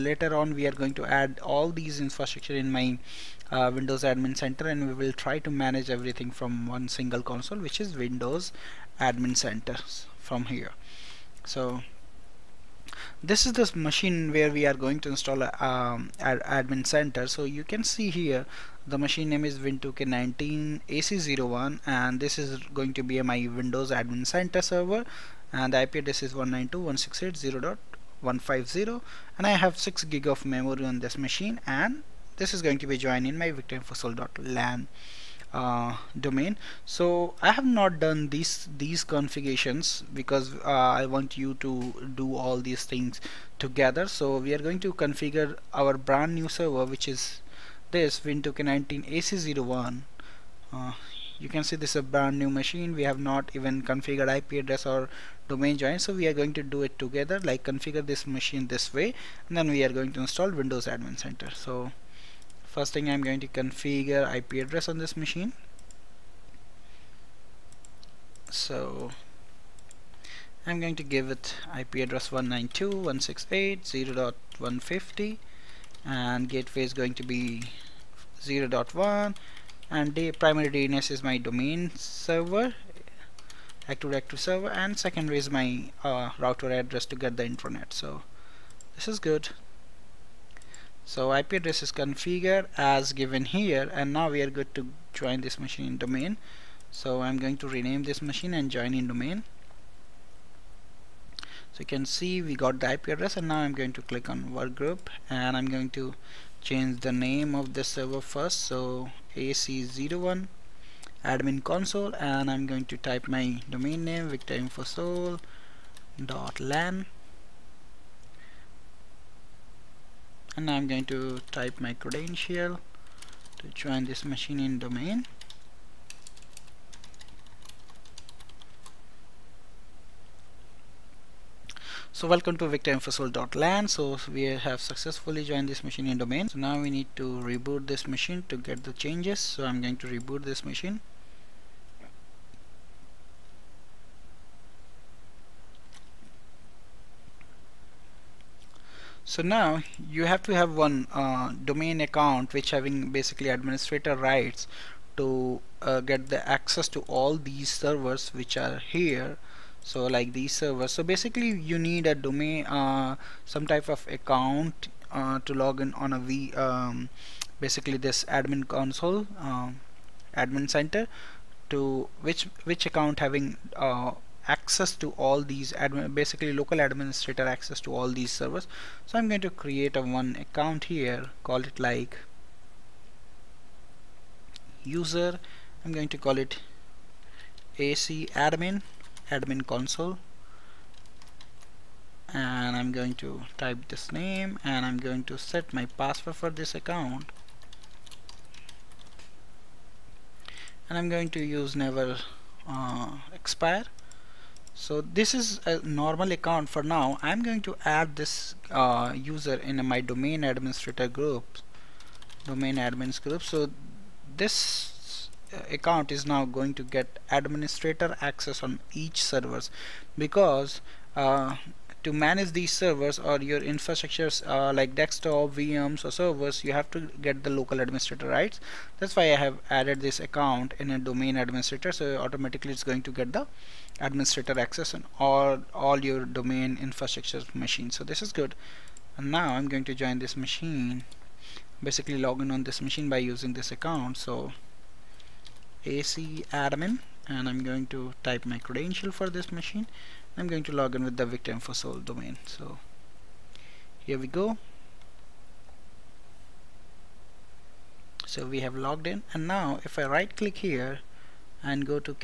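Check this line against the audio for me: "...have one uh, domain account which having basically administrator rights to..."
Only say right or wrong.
right.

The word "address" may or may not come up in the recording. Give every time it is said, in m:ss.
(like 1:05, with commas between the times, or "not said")
0:25, 0:54, 1:04, 1:11, 1:26, 1:31, 1:43.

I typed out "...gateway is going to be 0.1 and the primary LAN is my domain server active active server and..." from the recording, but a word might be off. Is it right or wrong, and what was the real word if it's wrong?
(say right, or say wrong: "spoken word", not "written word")
wrong: "DNS", not "LAN".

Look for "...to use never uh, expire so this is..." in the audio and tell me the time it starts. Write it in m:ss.
3:21.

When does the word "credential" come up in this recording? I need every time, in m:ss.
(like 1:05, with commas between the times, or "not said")
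2:02, 4:08.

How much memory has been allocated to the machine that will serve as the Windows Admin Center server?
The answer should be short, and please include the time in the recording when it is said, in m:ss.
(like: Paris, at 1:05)
6 GB, at 0:29.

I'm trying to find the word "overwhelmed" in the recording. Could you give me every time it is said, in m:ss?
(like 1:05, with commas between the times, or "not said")
not said.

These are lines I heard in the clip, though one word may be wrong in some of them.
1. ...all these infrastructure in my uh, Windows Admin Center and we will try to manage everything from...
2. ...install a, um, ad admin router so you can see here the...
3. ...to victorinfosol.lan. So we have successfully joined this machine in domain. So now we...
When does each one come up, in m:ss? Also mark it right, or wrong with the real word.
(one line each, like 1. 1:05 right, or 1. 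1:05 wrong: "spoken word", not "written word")
1. 0:01 right
2. 0:15 wrong: "center", not "router"
3. 2:12 right.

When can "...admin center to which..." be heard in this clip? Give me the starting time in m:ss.
2:50.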